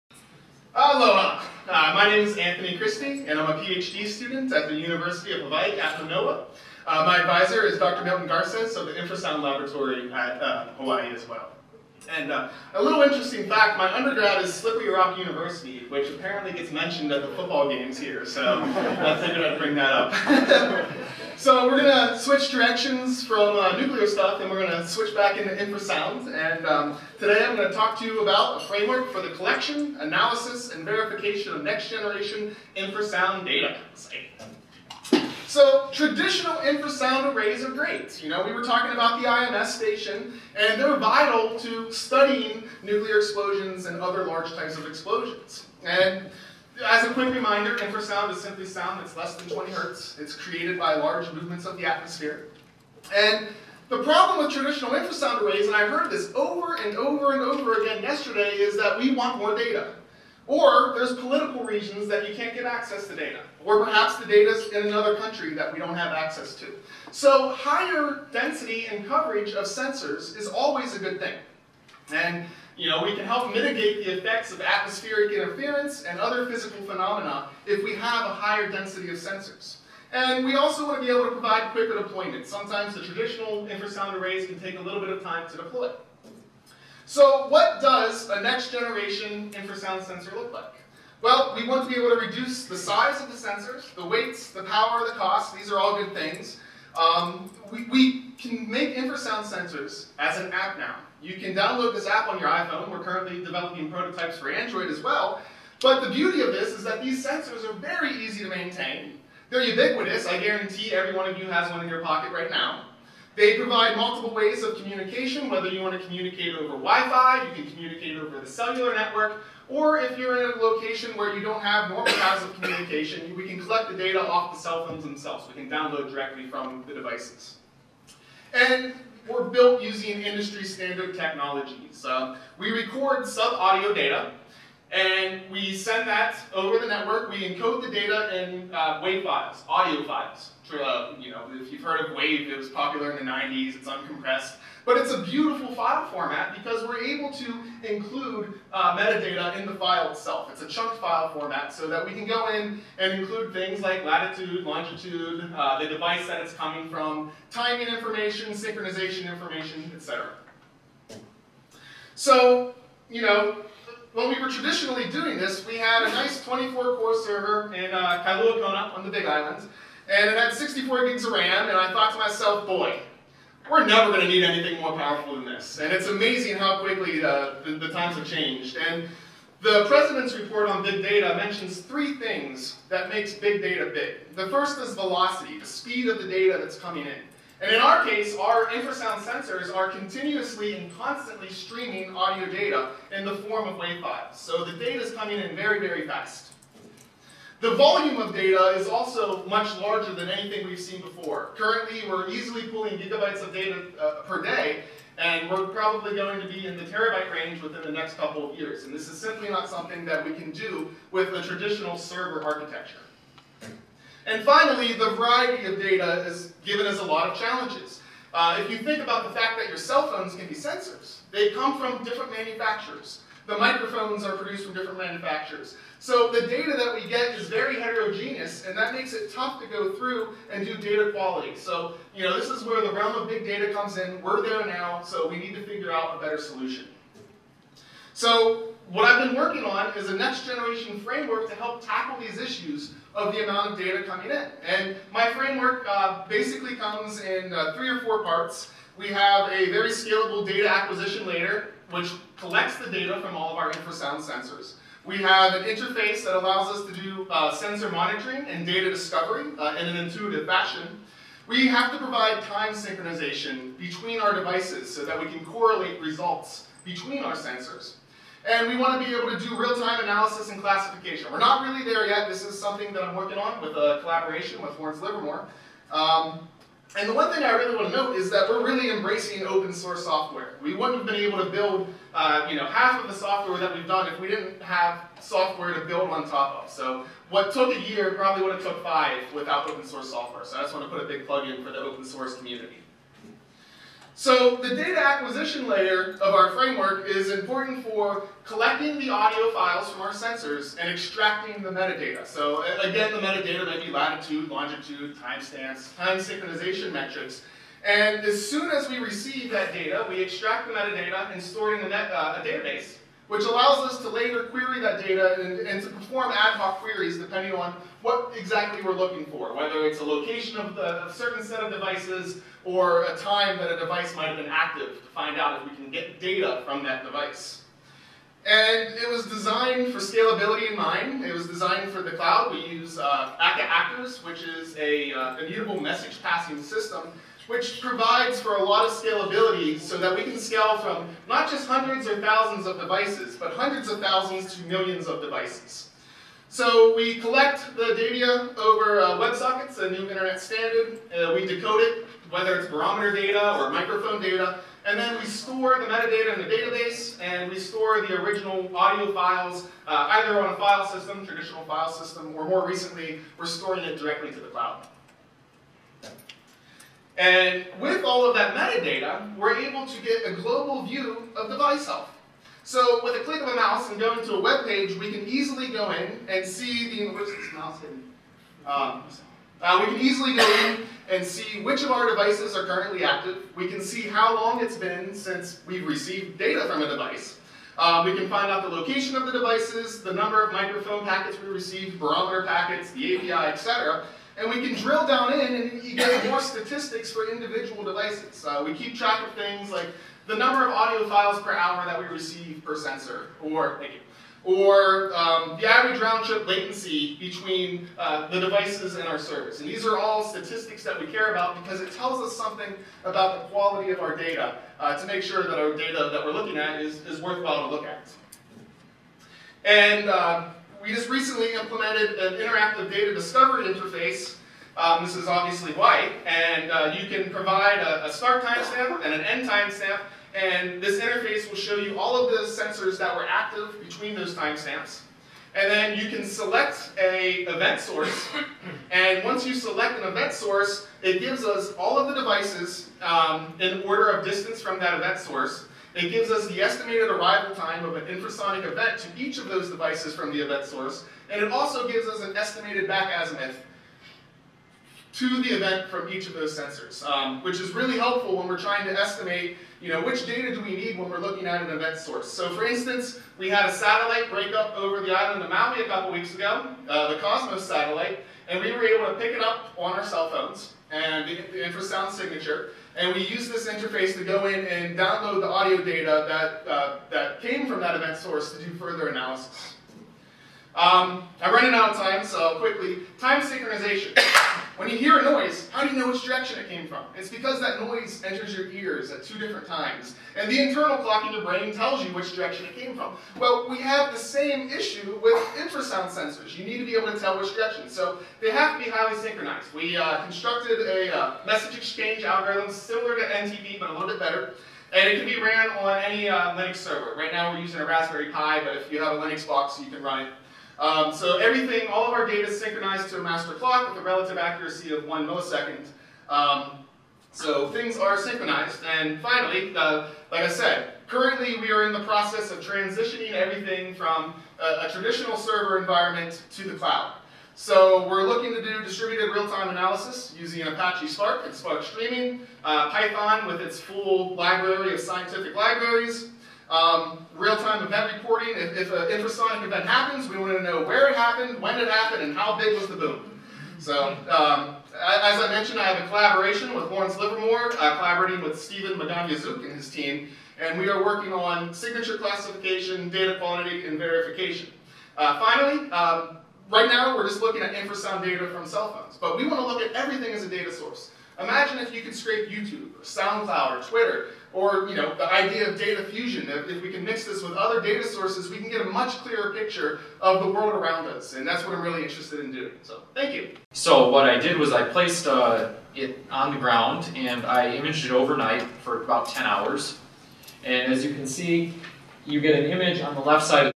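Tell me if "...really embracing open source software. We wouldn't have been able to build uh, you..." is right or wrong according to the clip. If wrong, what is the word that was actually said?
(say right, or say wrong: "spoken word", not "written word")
right.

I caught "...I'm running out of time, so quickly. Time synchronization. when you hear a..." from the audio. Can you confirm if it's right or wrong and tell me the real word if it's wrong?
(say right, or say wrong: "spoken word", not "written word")
right.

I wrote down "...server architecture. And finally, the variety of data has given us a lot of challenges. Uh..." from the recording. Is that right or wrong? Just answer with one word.
right.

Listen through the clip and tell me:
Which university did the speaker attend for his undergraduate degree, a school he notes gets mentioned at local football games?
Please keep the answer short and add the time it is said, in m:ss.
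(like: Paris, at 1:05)
Slippery Rock University, at 0:14.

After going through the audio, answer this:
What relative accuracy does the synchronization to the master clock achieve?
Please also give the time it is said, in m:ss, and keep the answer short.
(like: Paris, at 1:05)
1 millisecond, at 8:35.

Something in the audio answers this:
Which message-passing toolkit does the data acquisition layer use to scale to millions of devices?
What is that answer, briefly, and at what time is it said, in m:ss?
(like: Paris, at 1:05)
Akka Actors, at 5:33.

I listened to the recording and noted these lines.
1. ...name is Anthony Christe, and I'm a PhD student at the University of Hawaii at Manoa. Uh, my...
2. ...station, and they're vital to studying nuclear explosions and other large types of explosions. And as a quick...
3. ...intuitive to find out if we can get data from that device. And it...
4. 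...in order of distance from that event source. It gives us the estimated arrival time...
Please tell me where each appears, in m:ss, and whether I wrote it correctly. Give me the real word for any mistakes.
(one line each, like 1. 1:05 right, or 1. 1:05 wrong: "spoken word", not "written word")
1. 0:02 right
2. 0:39 right
3. 5:24 wrong: "active", not "intuitive"
4. 7:23 right.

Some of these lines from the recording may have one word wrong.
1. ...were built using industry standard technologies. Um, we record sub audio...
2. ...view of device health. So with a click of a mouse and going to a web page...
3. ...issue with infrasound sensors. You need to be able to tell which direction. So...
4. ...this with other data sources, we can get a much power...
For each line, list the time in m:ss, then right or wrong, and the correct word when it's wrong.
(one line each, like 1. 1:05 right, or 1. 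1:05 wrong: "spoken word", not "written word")
1. 2:09 right
2. 6:10 right
3. 8:14 right
4. 9:27 wrong: "clearer", not "power".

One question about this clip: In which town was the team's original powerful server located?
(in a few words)
Kailua Kona.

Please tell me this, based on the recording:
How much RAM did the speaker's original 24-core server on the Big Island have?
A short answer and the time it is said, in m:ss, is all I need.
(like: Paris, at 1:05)
64 gigs, at 2:50.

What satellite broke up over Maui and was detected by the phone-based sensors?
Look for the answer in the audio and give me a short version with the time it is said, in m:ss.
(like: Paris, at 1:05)
Cosmos, at 7:47.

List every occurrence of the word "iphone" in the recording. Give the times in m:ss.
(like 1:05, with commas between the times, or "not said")
1:42.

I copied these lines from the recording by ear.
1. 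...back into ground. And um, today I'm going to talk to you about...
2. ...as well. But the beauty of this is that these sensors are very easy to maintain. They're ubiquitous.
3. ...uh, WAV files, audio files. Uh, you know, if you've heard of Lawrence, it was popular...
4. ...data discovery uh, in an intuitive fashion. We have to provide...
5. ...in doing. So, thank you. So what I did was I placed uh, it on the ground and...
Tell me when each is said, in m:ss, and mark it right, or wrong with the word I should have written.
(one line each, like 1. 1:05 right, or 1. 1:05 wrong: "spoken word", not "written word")
1. 0:25 wrong: "infrasound", not "ground"
2. 1:44 right
3. 2:18 wrong: "WAV", not "Lawrence"
4. 4:18 right
5. 9:32 right.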